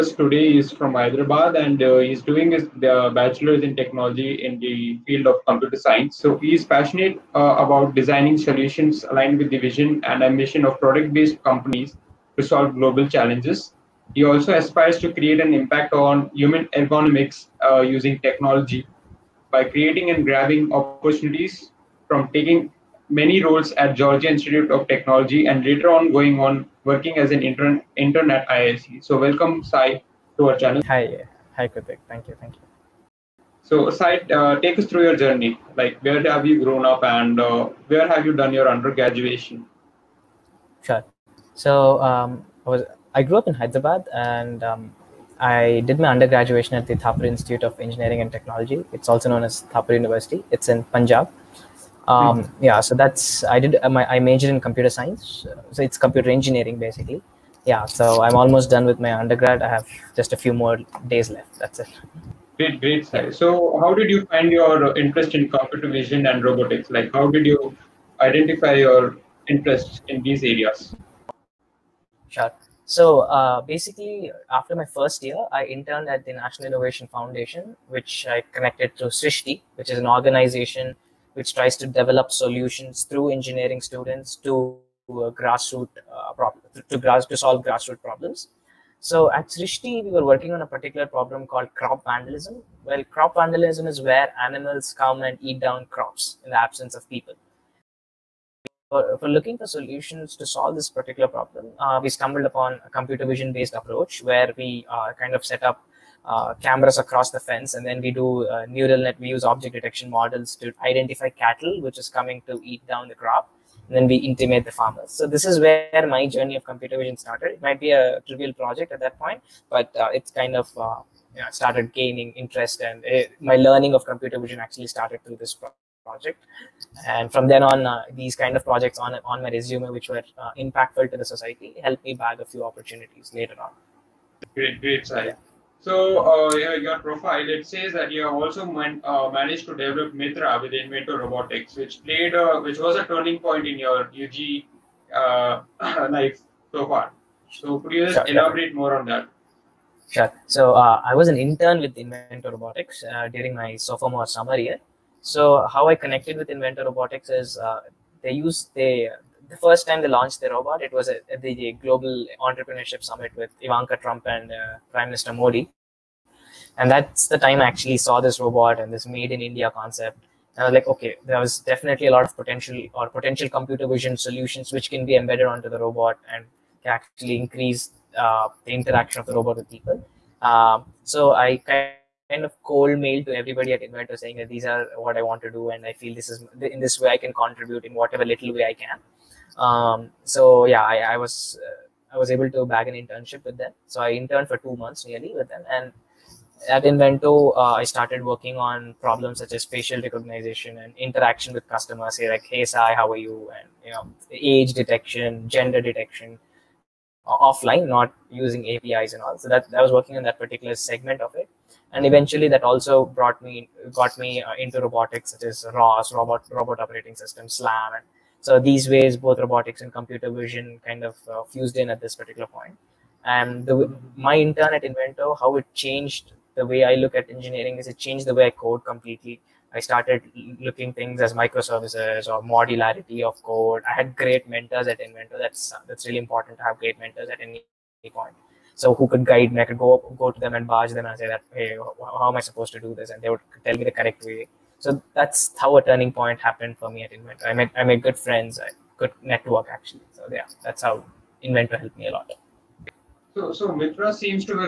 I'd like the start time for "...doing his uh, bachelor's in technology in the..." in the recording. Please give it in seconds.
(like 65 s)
2 s.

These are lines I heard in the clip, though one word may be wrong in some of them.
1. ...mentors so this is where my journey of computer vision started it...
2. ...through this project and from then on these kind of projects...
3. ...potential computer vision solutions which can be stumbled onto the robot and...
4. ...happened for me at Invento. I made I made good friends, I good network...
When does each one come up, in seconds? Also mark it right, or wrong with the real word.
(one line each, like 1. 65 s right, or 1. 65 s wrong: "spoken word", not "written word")
1. 114 s wrong: "farmers", not "mentors"
2. 125 s right
3. 173 s wrong: "embedded", not "stumbled"
4. 246 s right.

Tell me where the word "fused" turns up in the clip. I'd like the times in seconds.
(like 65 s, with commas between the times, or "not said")
221 s.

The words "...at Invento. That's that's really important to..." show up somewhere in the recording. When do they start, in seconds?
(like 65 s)
234 s.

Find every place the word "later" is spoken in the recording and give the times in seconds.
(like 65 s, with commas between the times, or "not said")
25 s, 133 s.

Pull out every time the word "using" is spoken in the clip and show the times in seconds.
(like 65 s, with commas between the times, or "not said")
17 s, 208 s.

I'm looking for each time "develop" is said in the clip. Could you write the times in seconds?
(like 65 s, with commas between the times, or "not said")
81 s, 139 s.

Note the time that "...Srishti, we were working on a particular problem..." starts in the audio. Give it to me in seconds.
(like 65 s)
89 s.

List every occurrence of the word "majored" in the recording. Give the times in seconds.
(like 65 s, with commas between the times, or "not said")
54 s.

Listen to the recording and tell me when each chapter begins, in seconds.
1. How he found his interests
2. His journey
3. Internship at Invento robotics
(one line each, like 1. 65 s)
1. 61 s
2. 32 s
3. 133 s.